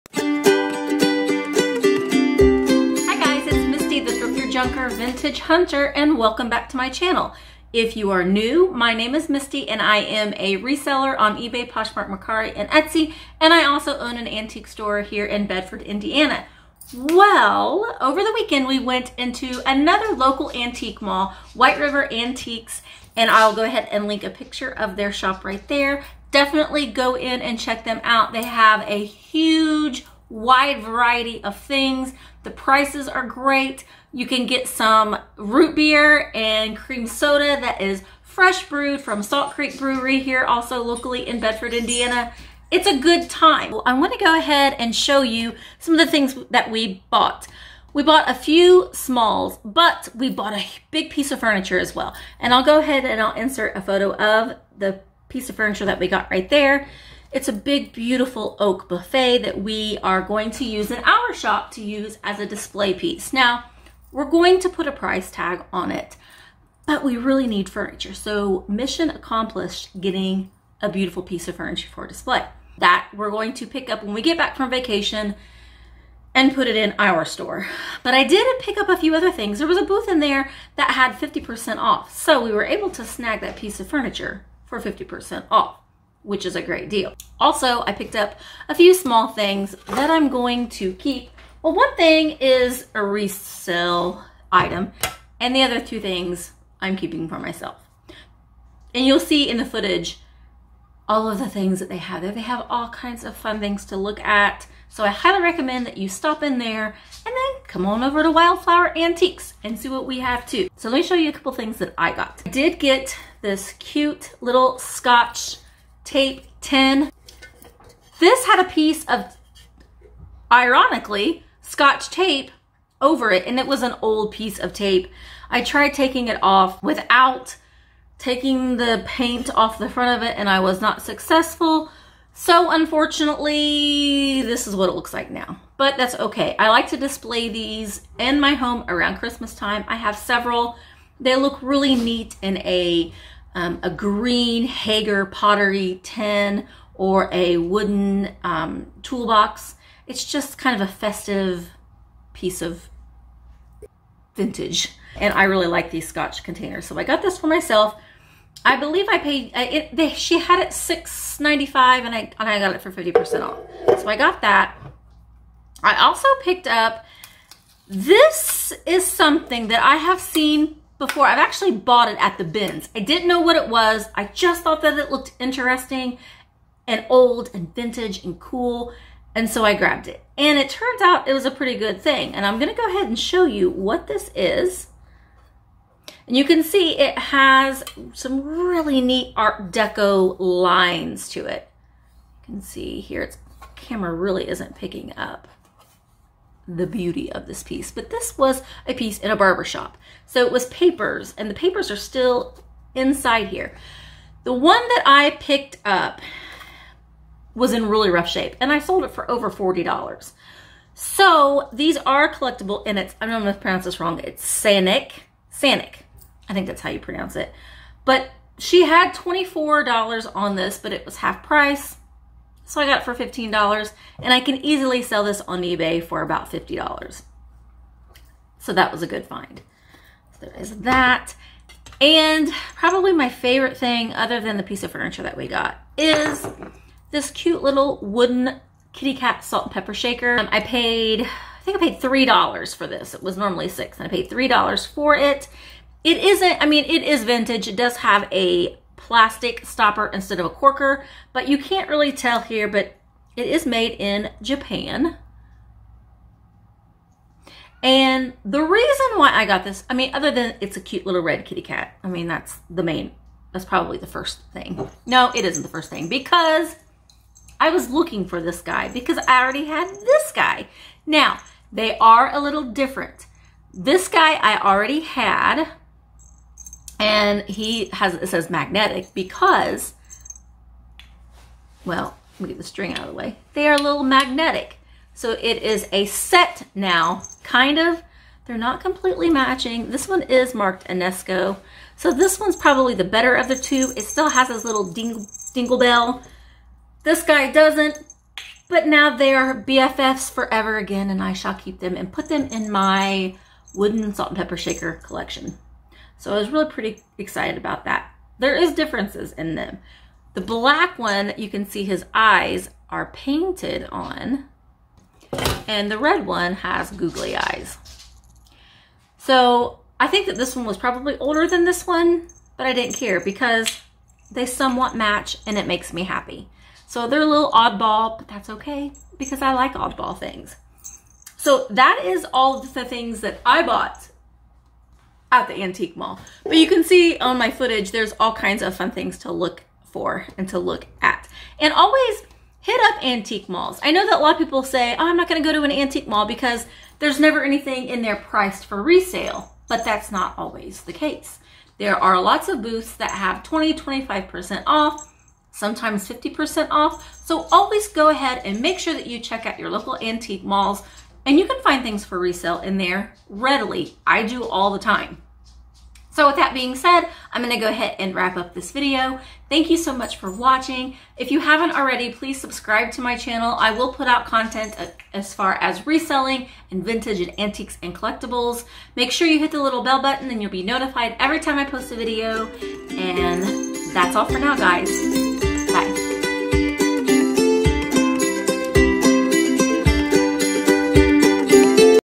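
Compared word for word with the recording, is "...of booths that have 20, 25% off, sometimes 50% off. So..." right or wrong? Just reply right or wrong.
right.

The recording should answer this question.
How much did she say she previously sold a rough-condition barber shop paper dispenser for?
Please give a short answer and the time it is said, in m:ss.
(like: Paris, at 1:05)
over $40, at 3:29.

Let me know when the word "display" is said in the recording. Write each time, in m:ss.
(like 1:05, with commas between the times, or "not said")
1:02, 1:12, 2:16.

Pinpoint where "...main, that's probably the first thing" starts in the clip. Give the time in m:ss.
4:22.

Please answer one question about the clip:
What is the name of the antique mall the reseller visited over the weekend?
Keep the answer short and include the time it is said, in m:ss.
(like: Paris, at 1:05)
White River Antiques, at 0:21.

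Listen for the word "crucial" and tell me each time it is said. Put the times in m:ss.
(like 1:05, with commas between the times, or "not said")
not said.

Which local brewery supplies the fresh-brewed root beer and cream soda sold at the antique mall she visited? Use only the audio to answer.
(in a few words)
Salt Creek Brewery.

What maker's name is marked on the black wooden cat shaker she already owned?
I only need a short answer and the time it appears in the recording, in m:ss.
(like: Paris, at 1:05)
Enesco, at 4:50.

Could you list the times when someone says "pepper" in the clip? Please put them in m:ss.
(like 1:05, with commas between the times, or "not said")
3:59, 5:04.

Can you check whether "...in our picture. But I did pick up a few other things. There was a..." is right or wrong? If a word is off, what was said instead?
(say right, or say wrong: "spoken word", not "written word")
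wrong: "store", not "picture".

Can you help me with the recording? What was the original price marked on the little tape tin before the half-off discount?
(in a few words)
$6.95.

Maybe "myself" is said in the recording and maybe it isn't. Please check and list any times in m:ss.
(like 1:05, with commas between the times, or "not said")
1:37, 2:37.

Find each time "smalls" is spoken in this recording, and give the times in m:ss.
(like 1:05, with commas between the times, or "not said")
0:48, 1:28.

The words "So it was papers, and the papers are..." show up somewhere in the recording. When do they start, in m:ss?
3:20.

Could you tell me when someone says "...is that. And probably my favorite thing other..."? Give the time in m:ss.
3:50.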